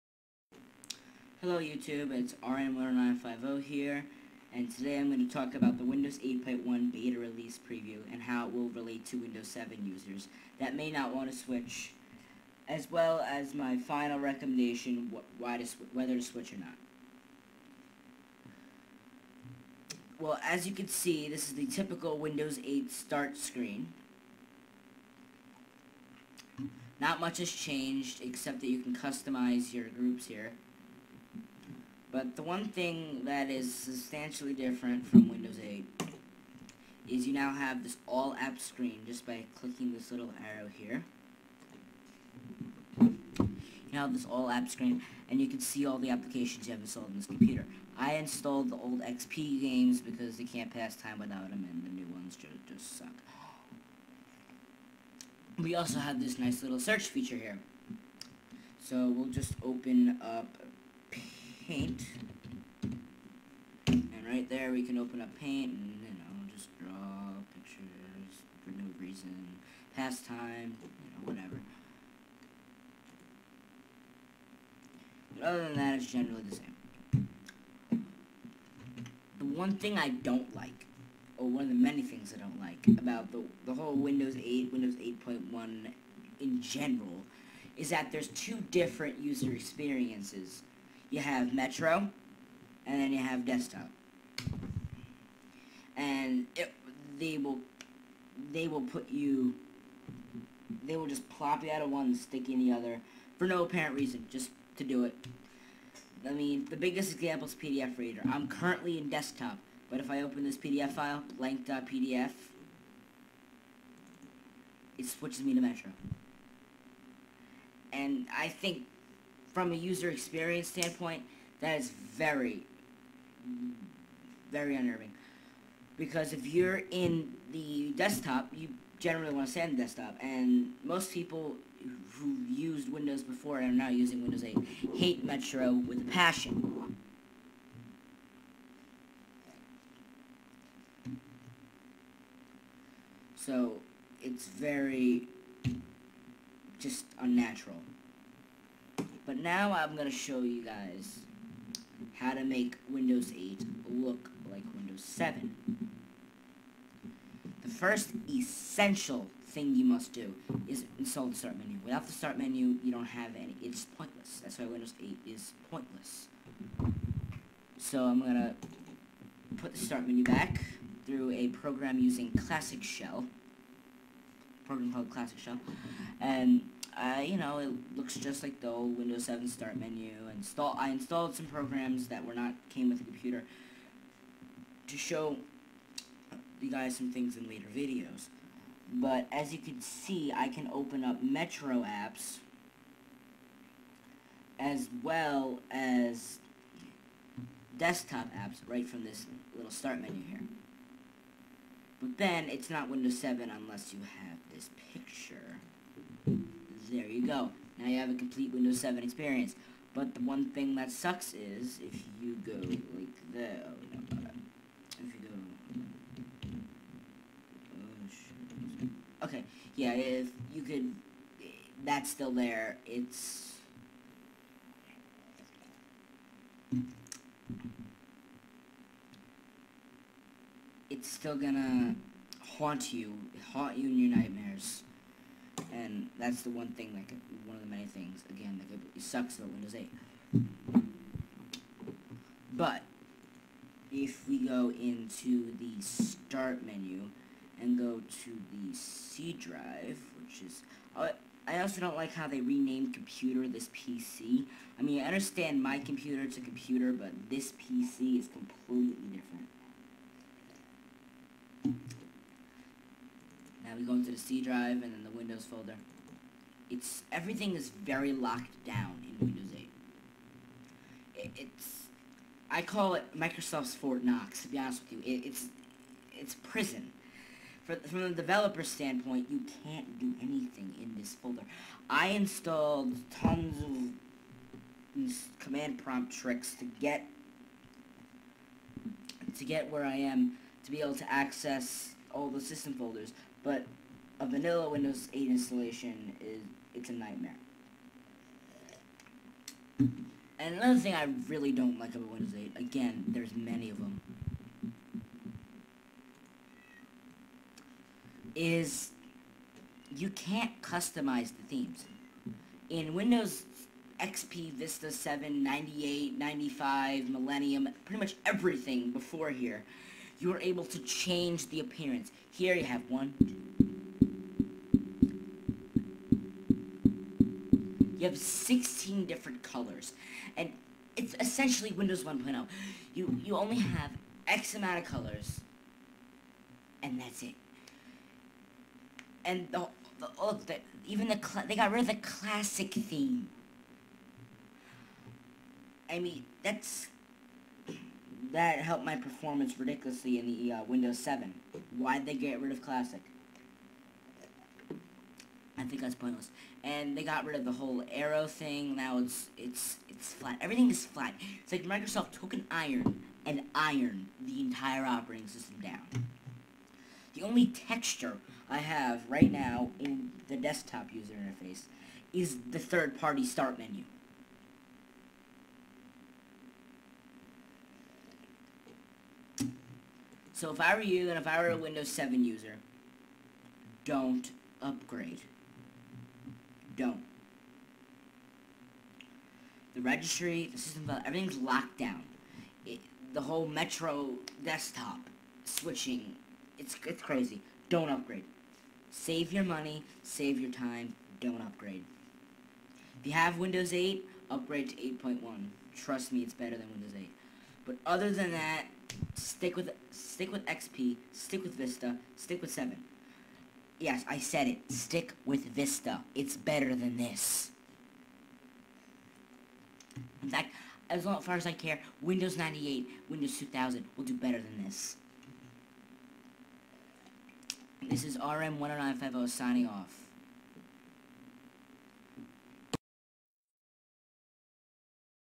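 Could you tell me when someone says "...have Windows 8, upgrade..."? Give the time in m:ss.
6:43.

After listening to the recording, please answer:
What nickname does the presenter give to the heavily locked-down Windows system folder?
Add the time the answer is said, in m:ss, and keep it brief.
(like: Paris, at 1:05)
Microsoft's Fort Knox, at 4:33.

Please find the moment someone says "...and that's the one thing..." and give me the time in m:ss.
3:55.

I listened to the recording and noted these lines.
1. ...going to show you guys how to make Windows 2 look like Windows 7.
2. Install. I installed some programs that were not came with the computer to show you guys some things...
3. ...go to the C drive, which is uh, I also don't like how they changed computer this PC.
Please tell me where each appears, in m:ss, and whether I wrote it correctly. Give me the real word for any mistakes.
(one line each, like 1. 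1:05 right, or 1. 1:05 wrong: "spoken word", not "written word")
1. 2:29 wrong: "8", not "2"
2. 3:00 right
3. 4:07 wrong: "renamed", not "changed".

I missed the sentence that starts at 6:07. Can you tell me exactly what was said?
The only texture I have right now in the desktop user interface is the third-party start menu.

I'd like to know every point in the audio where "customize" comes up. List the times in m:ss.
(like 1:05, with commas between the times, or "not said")
0:28, 5:10.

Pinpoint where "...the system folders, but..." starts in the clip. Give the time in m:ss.
4:52.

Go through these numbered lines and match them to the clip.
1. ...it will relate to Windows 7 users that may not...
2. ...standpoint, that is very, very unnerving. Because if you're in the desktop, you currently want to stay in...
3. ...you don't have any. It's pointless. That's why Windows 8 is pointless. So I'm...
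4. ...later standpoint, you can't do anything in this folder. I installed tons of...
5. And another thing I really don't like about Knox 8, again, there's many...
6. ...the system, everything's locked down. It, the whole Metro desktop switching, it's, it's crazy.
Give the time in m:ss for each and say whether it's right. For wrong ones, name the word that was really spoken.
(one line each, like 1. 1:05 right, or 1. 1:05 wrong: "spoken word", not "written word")
1. 0:08 right
2. 2:00 wrong: "generally", not "currently"
3. 2:42 right
4. 4:38 wrong: "developer", not "later"
5. 4:59 wrong: "Windows", not "Knox"
6. 6:30 right.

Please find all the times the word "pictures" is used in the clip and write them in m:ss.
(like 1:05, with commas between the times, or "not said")
1:07, 3:24.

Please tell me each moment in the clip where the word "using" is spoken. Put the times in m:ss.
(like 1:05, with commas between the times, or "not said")
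2:13, 2:51.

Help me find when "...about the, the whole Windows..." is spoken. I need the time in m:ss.
1:22.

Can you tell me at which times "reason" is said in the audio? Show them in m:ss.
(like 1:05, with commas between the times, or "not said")
1:08, 1:43.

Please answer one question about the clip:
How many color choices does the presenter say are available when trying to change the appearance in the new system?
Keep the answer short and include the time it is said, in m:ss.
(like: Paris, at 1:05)
16, at 5:28.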